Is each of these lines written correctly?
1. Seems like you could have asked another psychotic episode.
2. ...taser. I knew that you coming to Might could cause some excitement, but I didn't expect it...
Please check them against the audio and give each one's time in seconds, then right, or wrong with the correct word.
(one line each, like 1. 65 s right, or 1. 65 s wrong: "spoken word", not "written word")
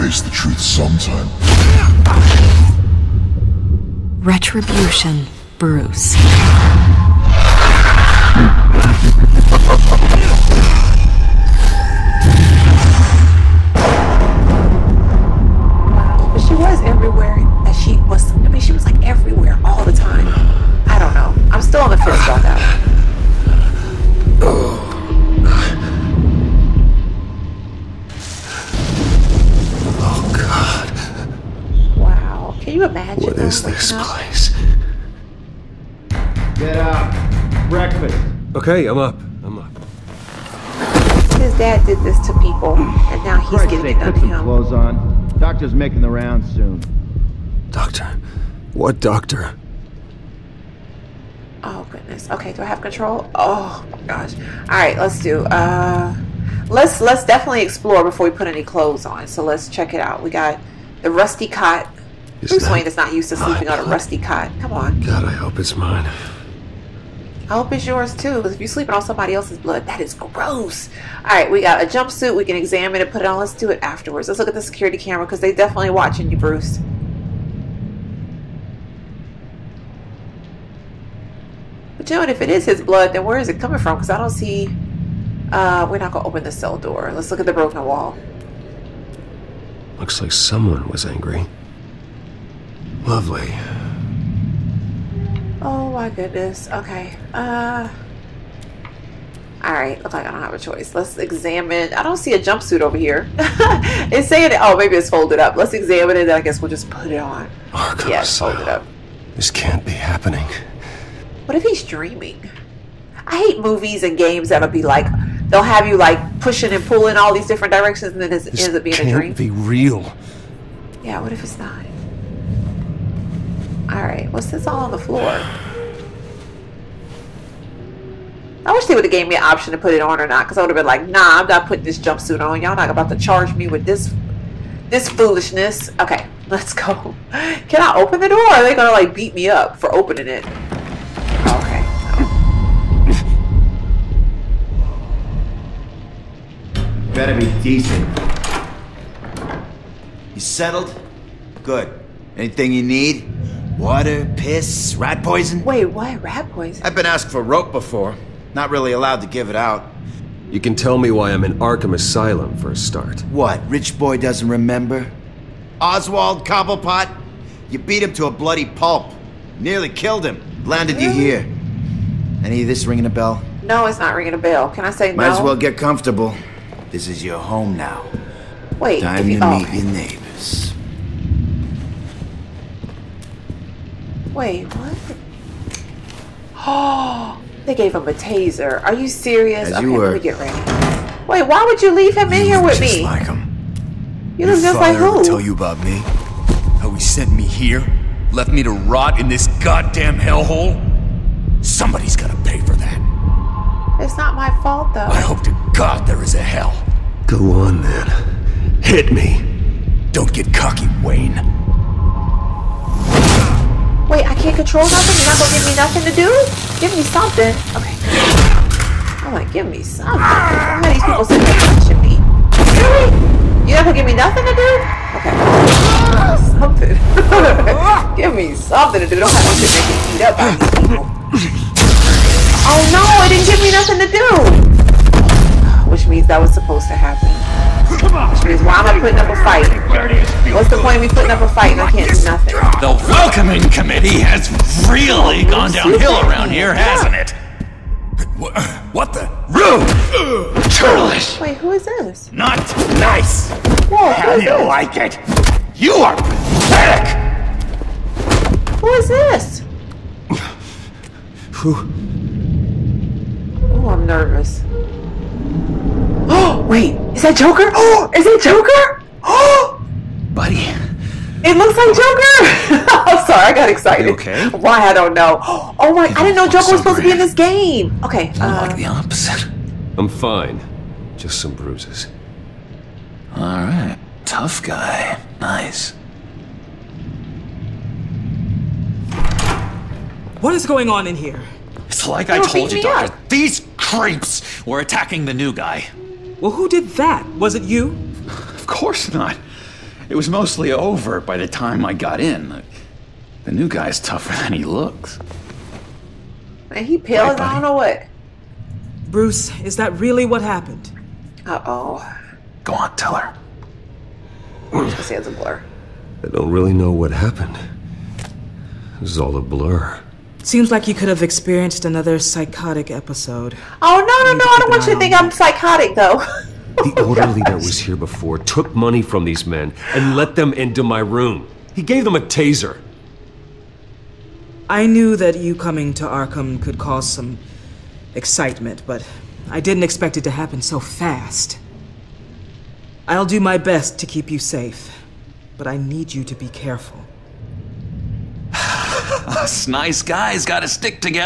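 1. 320 s wrong: "experienced", not "asked"
2. 332 s wrong: "Arkham", not "Might".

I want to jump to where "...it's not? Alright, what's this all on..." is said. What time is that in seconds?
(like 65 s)
121 s.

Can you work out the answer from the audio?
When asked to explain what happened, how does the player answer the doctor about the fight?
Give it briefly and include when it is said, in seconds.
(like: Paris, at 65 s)
It's a blur, at 315 s.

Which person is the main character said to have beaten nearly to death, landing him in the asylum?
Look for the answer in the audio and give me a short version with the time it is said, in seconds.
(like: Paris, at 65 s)
Oswald Cobblepot, at 165 s.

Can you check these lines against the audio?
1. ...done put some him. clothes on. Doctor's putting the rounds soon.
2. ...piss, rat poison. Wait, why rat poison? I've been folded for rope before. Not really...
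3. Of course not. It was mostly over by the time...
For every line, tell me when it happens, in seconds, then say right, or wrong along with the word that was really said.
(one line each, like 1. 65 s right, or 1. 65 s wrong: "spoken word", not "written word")
1. 43 s wrong: "making", not "putting"
2. 154 s wrong: "asked", not "folded"
3. 298 s right.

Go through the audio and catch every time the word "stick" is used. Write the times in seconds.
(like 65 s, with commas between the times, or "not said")
350 s.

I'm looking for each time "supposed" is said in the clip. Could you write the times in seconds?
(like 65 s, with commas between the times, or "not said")
236 s, 276 s.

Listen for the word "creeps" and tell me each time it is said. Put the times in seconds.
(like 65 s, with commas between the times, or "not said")
293 s.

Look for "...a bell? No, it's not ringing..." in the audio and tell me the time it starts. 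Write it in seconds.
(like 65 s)
173 s.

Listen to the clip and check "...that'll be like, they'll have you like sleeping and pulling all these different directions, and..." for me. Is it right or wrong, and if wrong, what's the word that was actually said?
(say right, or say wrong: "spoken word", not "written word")
wrong: "pushing", not "sleeping".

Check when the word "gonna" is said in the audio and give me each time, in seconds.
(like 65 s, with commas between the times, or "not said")
86 s, 138 s, 215 s, 223 s, 314 s.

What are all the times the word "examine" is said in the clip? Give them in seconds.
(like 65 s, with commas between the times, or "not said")
72 s, 101 s, 105 s.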